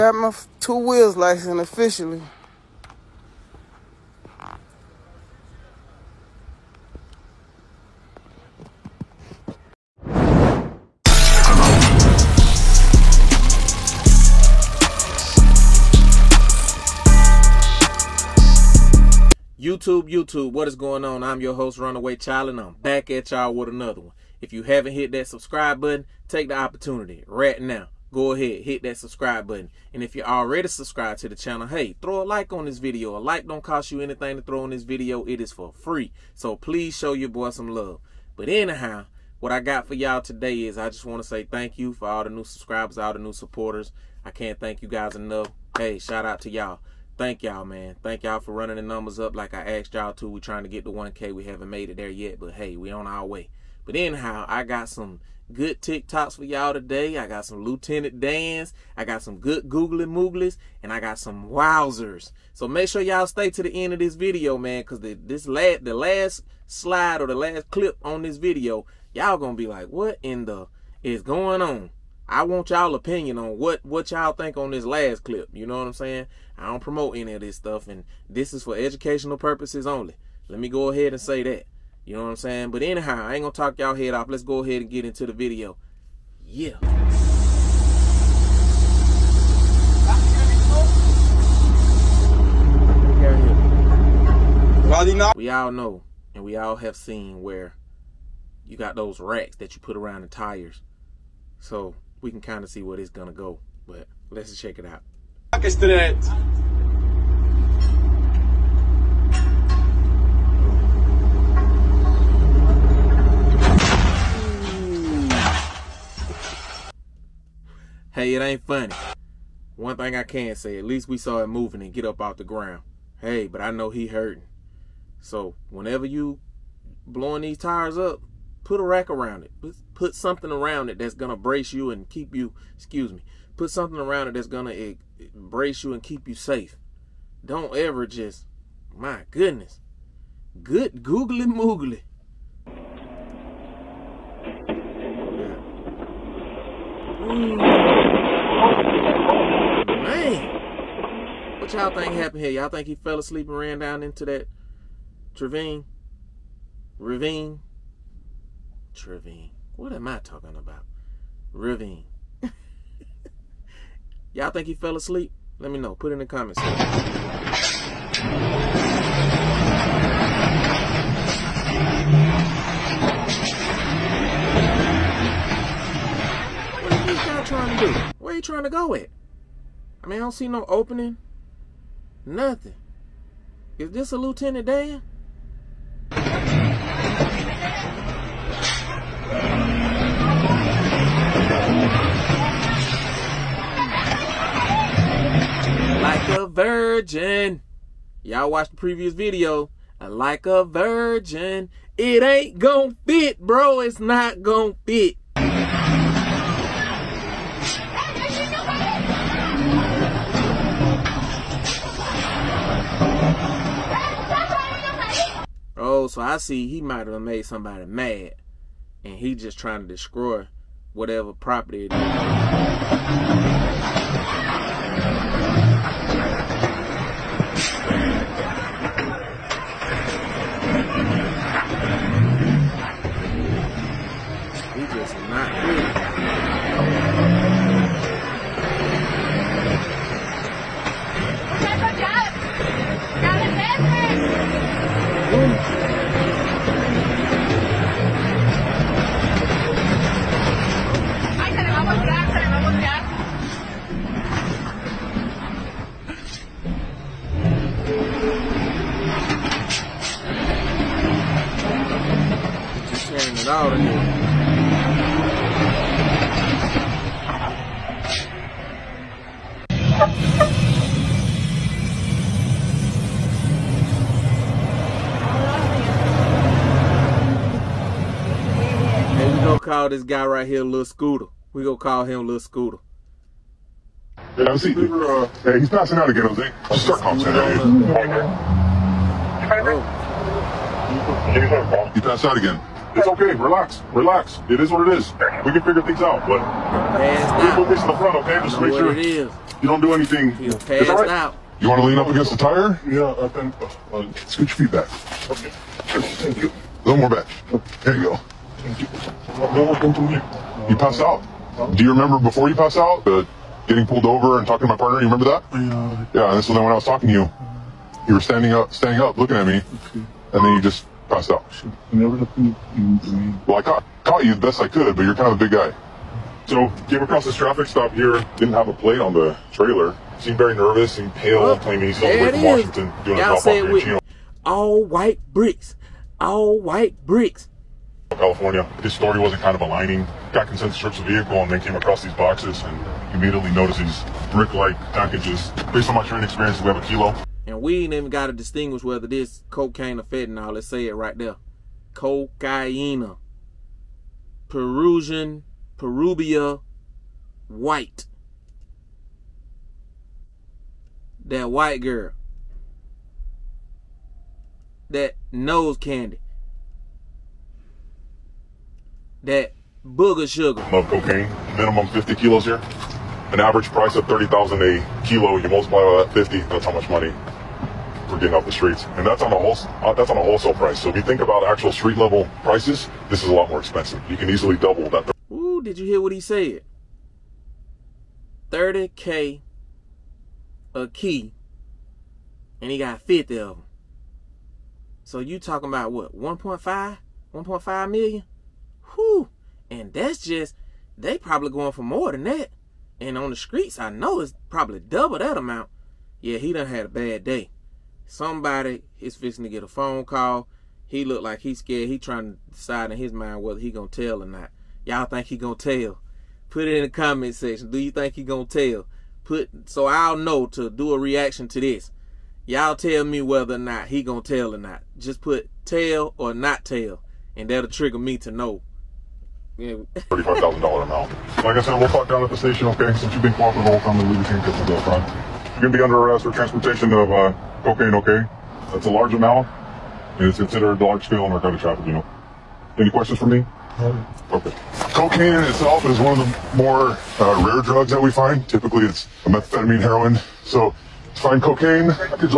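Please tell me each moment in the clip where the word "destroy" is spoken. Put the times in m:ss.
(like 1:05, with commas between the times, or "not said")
3:39.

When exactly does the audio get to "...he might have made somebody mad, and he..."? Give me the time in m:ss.
3:36.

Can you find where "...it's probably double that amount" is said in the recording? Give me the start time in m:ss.
6:44.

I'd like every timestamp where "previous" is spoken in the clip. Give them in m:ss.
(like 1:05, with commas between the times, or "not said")
3:18.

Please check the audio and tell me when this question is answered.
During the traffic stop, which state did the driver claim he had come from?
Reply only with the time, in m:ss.
5:32.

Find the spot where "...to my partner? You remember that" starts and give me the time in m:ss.
5:14.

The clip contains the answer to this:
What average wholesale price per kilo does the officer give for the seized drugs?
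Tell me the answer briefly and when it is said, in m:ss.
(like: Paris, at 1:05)
30,000, at 6:14.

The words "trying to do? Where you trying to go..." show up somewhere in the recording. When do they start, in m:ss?
2:57.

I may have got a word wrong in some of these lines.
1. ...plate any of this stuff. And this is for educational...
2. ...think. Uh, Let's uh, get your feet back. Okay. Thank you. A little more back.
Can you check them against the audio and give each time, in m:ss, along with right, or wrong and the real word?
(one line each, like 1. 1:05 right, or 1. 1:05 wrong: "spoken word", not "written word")
1. 1:16 wrong: "promote", not "plate"
2. 5:03 right.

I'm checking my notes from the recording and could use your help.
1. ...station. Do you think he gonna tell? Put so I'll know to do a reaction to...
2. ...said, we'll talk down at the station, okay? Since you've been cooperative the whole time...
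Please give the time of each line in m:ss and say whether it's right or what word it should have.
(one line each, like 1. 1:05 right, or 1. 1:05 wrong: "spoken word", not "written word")
1. 6:57 wrong: "section", not "station"
2. 7:11 right.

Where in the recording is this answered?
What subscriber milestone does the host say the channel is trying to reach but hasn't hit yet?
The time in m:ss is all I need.
0:50.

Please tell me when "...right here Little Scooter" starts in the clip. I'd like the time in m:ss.
4:40.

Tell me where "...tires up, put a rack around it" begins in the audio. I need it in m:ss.
2:07.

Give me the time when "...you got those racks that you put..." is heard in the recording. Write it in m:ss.
1:38.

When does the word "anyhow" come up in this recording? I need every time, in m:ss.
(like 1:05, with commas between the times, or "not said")
0:38, 0:53, 1:22.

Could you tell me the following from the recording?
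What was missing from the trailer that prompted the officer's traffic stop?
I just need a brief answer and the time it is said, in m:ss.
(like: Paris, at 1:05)
a plate, at 5:28.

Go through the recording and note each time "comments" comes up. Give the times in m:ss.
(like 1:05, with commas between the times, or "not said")
2:46, 6:56.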